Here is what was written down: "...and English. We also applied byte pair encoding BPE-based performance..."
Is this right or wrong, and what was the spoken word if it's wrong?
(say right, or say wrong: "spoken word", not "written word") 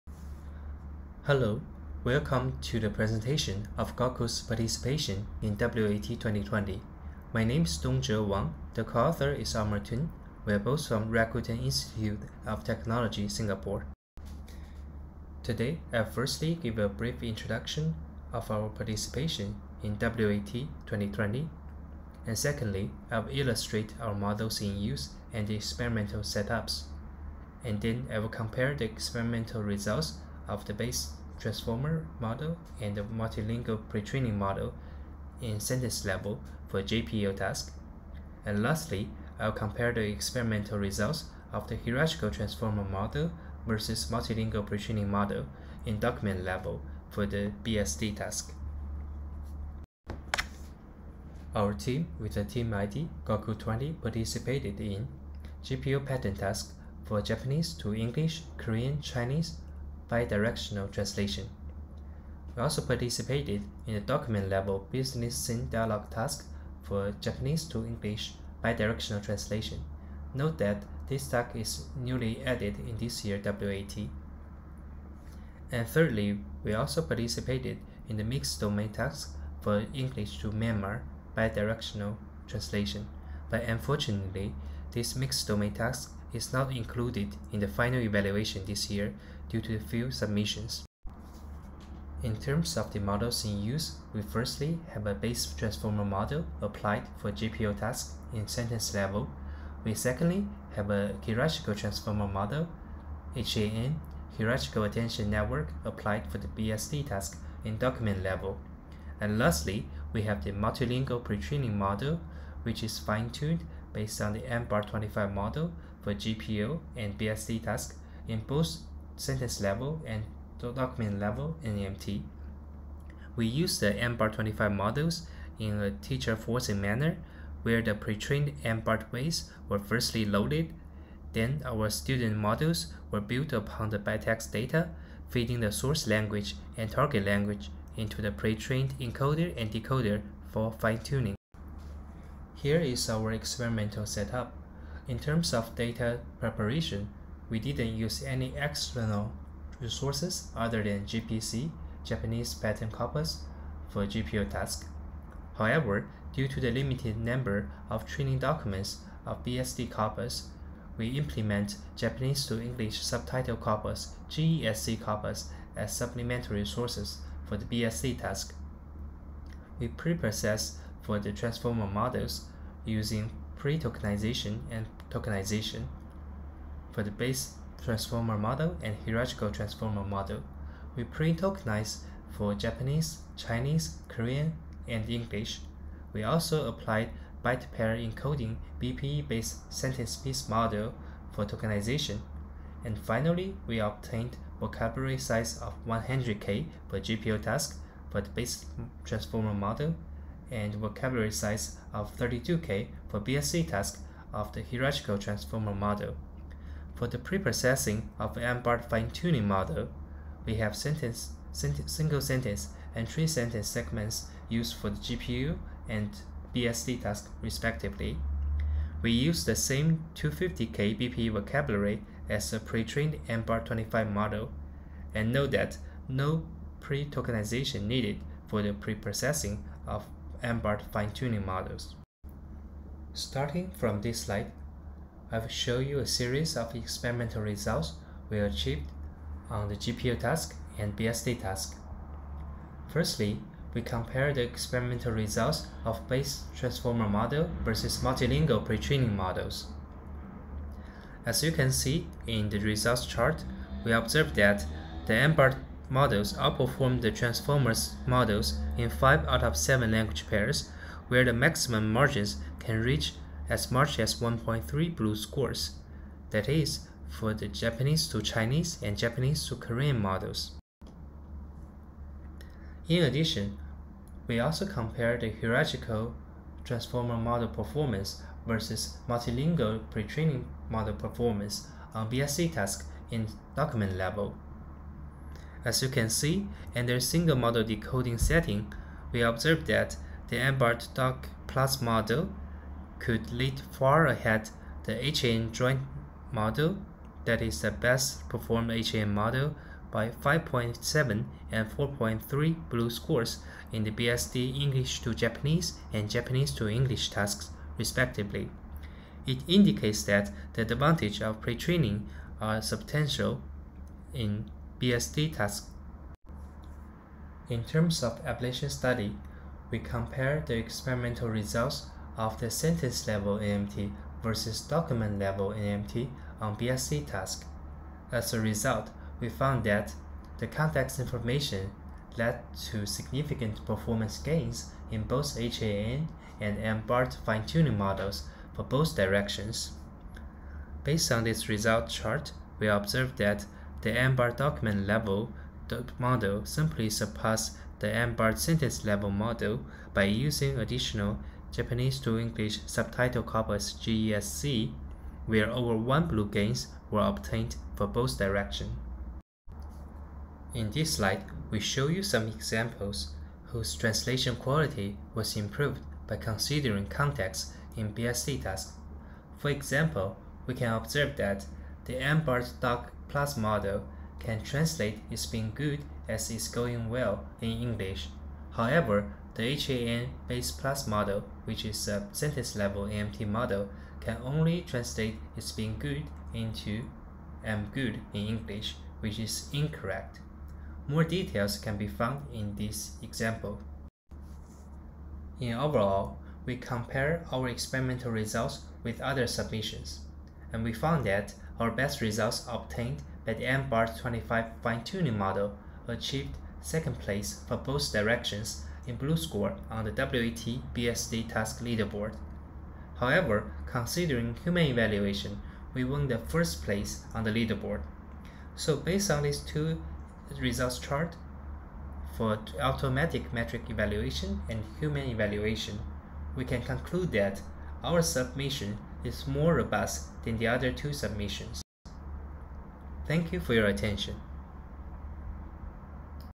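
wrong: "sentence", not "performance".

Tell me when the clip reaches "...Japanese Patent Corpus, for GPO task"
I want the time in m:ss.
2:32.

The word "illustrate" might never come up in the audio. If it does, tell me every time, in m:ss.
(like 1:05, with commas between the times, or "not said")
0:23.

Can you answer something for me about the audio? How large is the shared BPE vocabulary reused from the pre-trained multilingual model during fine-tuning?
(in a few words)
250k.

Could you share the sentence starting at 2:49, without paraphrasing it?
We pre-process for the transformer models using pre-tokenization and tokenization.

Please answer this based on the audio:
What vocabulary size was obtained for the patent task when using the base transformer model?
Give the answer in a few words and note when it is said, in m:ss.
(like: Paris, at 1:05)
100k, at 3:15.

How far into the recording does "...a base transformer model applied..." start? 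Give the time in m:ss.
1:35.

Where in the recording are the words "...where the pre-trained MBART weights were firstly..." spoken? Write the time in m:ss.
2:07.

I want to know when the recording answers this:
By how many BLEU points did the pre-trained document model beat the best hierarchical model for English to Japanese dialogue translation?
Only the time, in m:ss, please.
5:00.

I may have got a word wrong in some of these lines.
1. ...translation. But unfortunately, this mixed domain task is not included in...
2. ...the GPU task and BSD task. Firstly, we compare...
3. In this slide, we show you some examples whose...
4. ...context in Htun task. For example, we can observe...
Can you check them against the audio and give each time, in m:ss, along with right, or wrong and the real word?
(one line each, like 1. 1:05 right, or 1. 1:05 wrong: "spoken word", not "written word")
1. 1:22 right
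2. 3:59 right
3. 6:00 right
4. 6:06 wrong: "BSD", not "Htun".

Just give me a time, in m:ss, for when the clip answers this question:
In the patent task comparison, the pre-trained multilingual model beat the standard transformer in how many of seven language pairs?
4:18.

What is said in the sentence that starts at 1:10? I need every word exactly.
Note that this task is newly added in this year WAT.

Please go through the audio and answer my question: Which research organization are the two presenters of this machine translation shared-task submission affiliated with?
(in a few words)
Rakuten Institute of Technology.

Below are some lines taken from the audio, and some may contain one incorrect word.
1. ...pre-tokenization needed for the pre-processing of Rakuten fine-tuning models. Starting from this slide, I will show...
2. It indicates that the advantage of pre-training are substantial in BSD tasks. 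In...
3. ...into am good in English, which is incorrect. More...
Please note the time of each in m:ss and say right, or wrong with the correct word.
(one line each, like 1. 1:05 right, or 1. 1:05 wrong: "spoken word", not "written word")
1. 3:46 wrong: "MBART", not "Rakuten"
2. 5:09 right
3. 6:26 right.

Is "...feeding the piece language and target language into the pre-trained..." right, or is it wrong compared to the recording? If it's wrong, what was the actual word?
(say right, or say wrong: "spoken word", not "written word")
wrong: "source", not "piece".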